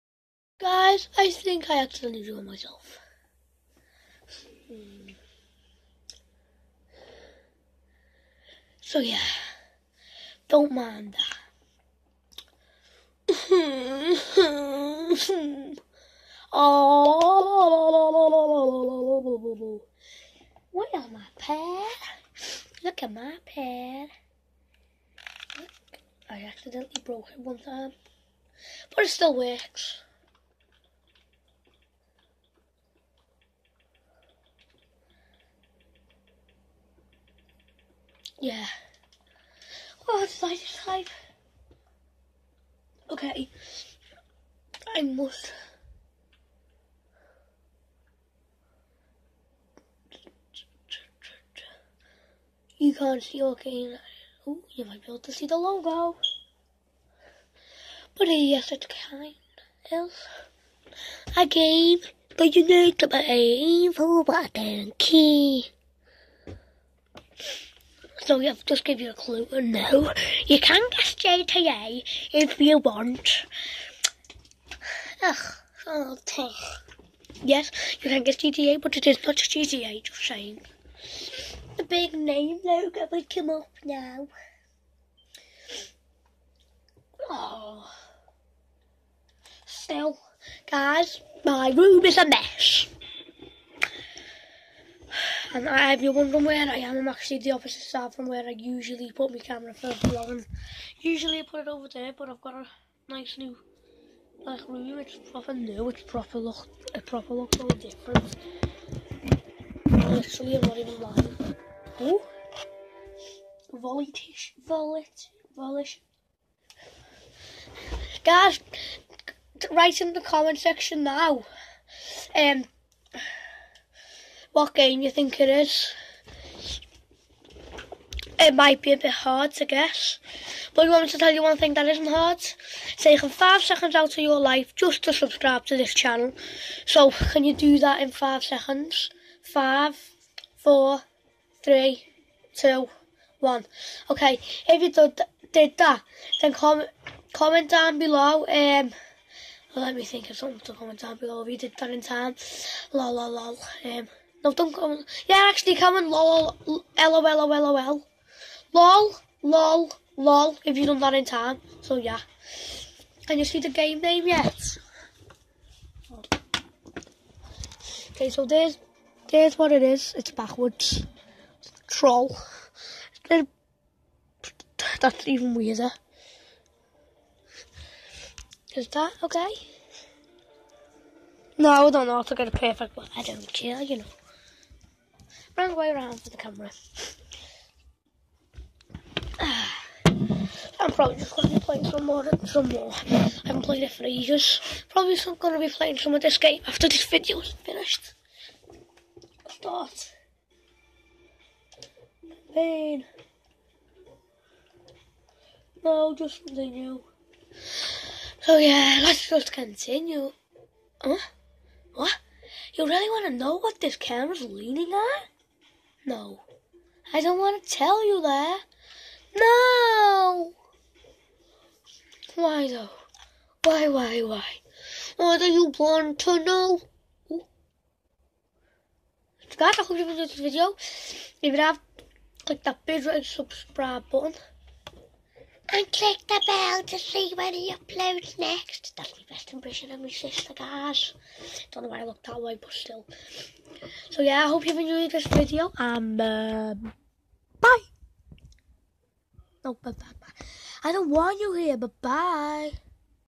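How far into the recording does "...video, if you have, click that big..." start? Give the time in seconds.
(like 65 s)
230 s.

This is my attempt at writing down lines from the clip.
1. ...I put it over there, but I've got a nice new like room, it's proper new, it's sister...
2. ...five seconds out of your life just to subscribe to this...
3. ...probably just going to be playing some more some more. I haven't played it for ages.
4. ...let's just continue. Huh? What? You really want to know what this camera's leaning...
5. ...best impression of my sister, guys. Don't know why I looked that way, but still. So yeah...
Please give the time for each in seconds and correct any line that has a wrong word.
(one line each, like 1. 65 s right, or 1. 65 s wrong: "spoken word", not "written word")
1. 101 s wrong: "proper", not "sister"
2. 133 s right
3. 190 s right
4. 209 s right
5. 239 s right.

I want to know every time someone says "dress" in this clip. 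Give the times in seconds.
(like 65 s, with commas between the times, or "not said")
not said.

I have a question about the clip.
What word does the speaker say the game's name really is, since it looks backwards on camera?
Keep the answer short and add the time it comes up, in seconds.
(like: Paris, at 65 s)
Troll, at 171 s.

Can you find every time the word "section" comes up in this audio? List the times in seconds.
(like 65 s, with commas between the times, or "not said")
120 s.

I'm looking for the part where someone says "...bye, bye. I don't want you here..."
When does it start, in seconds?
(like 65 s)
249 s.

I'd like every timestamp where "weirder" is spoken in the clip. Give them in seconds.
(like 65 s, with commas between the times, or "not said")
175 s.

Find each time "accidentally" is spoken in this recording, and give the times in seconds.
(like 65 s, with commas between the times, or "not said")
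1 s, 26 s.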